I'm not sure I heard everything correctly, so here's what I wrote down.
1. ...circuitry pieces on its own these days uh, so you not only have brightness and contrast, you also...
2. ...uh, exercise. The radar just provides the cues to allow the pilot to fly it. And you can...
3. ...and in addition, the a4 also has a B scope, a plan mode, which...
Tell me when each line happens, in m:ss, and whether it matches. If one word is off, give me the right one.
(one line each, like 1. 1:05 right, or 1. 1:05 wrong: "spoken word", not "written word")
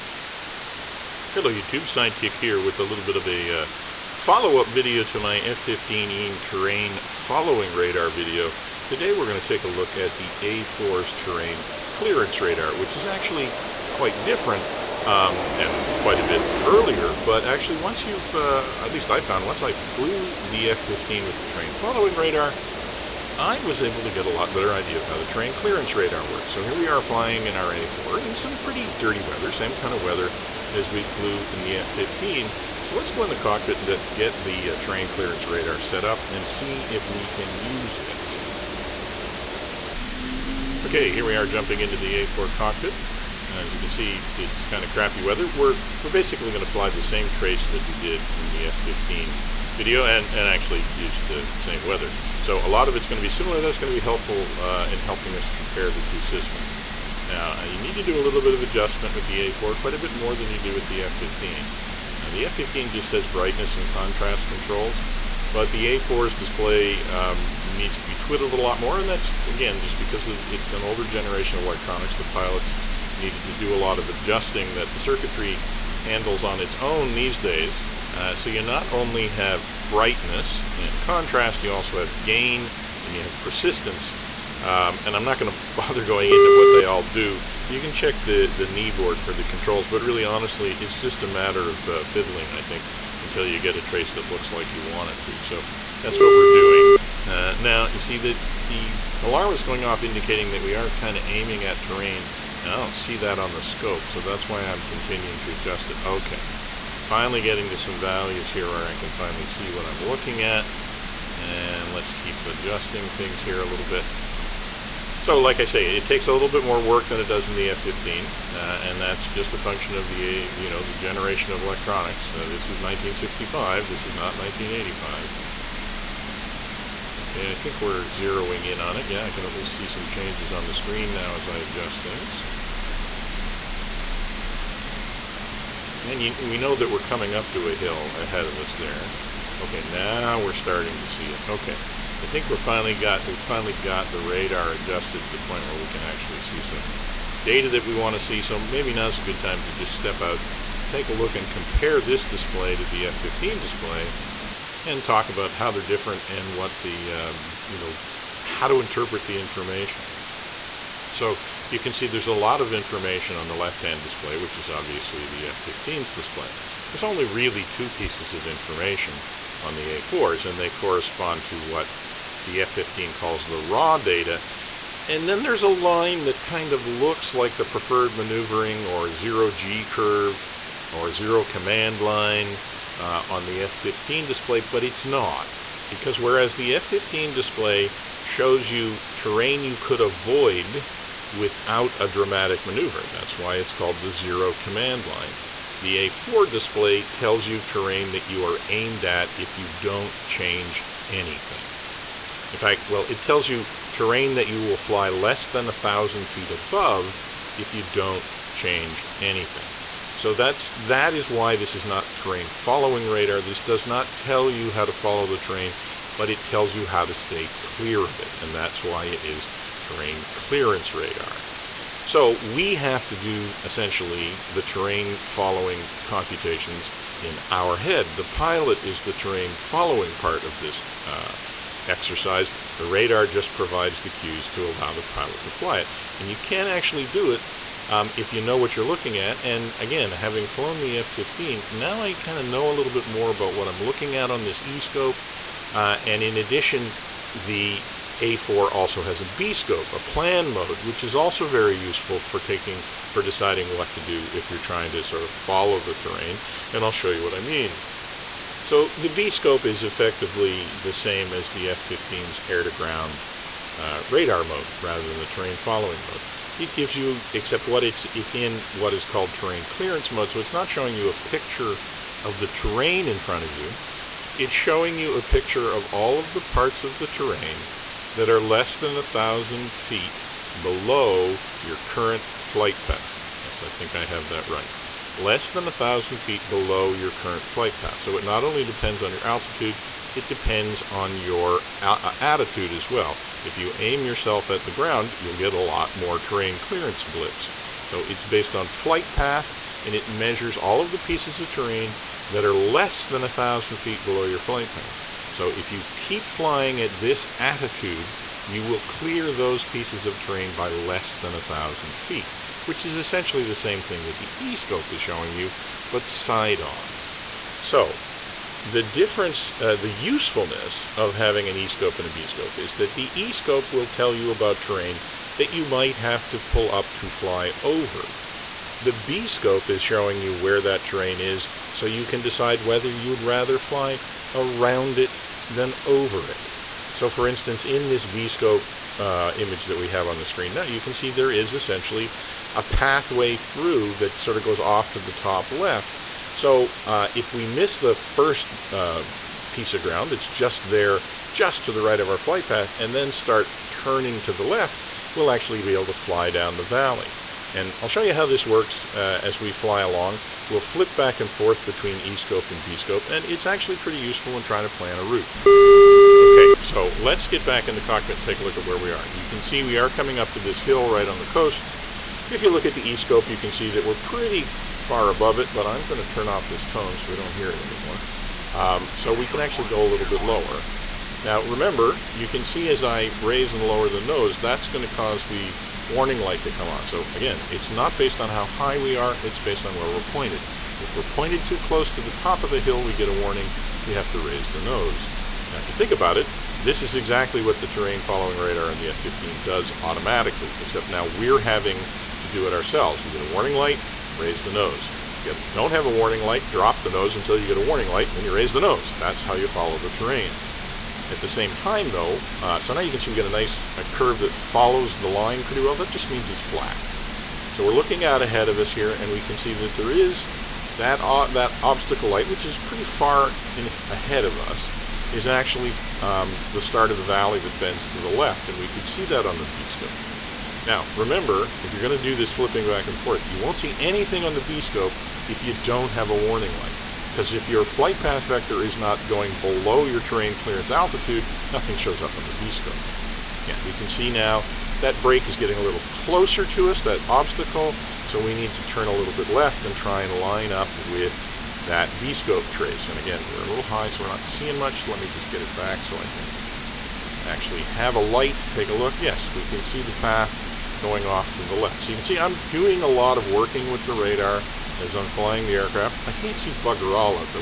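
1. 1:14 wrong: "handles", not "pieces"
2. 3:51 right
3. 4:06 right.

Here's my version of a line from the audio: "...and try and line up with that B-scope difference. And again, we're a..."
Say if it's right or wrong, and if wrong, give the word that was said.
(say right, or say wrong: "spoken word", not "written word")
wrong: "trace", not "difference".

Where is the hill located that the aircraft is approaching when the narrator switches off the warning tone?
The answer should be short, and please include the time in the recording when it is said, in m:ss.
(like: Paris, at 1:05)
on the coast, at 6:10.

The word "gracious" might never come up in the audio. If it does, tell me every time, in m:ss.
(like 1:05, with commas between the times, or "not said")
not said.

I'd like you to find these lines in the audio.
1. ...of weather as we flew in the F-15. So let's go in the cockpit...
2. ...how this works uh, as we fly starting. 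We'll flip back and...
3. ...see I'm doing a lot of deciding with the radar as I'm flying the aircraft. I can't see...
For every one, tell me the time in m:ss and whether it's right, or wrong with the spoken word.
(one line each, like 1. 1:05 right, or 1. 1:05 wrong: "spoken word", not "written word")
1. 0:29 right
2. 5:58 wrong: "along", not "starting"
3. 7:42 wrong: "working", not "deciding".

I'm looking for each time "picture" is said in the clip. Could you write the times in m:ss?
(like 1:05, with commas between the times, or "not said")
4:31, 4:35.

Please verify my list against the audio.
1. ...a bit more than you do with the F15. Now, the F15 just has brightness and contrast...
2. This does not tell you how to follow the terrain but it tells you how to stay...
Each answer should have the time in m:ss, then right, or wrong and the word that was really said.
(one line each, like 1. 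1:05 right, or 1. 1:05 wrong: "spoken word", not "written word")
1. 0:59 right
2. 3:33 right.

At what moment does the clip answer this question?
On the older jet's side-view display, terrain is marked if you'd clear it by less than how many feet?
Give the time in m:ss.
3:25.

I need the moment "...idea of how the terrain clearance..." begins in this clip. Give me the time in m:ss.
0:24.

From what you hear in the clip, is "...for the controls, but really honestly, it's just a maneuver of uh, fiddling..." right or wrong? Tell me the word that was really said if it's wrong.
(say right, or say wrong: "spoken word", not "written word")
wrong: "matter", not "maneuver".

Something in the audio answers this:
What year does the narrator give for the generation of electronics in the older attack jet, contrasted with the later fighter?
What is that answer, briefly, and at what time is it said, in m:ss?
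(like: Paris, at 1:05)
1965, at 2:02.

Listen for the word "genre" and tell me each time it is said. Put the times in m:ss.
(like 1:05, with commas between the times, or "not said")
not said.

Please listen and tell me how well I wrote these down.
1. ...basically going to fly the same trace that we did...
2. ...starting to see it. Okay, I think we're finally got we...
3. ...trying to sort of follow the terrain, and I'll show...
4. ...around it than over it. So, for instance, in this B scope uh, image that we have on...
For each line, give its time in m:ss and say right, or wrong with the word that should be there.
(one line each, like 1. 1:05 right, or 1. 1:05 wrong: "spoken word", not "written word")
1. 0:46 right
2. 2:20 right
3. 4:14 right
4. 5:34 right.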